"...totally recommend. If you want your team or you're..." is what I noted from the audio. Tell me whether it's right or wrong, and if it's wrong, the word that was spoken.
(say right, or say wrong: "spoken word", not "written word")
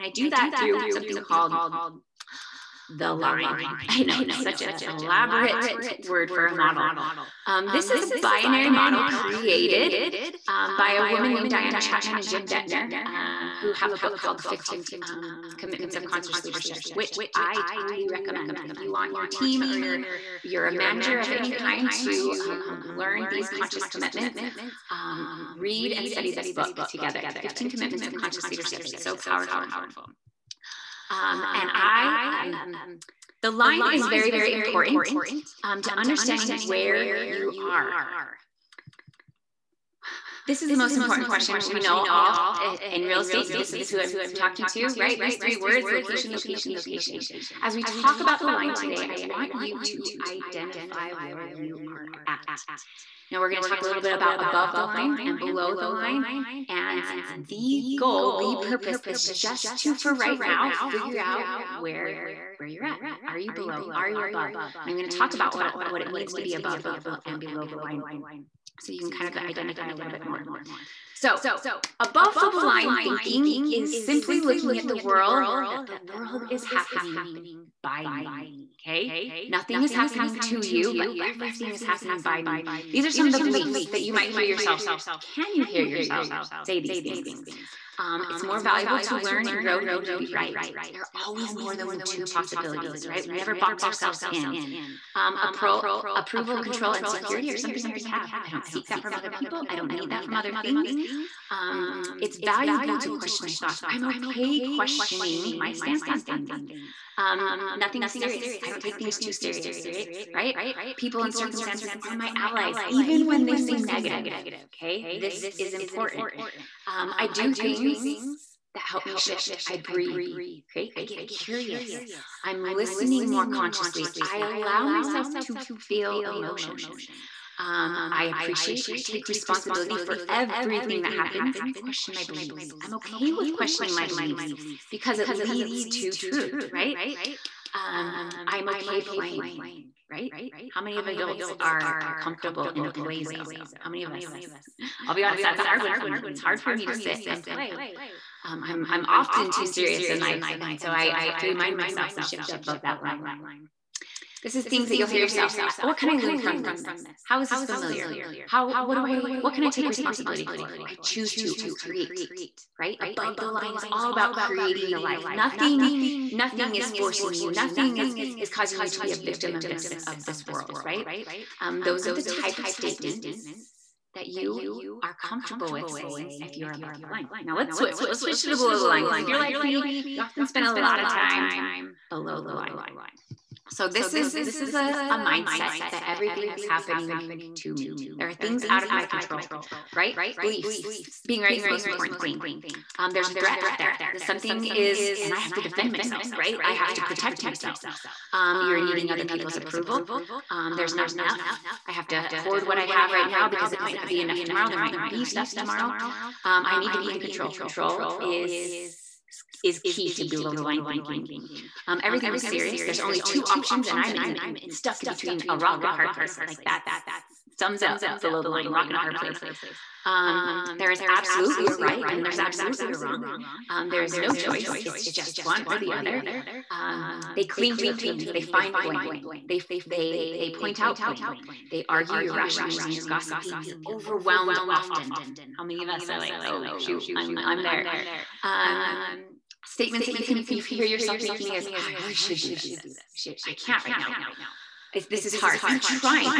right.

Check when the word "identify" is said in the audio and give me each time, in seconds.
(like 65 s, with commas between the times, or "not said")
50 s, 69 s.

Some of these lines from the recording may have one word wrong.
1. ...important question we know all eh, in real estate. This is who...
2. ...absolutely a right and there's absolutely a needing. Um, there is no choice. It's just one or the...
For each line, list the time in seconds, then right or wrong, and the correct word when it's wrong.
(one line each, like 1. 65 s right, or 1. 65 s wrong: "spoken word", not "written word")
1. 40 s right
2. 221 s wrong: "wrong", not "needing".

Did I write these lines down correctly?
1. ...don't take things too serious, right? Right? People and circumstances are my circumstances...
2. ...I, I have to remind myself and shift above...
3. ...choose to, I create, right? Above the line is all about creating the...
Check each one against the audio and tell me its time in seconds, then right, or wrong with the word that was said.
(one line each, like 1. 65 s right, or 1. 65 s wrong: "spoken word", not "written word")
1. 108 s wrong: "allies", not "circumstances"
2. 150 s right
3. 161 s right.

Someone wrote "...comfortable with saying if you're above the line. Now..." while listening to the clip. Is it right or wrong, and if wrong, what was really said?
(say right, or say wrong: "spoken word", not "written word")
right.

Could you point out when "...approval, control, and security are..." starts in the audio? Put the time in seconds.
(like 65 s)
95 s.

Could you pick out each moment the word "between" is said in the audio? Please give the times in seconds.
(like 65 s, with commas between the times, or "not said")
215 s.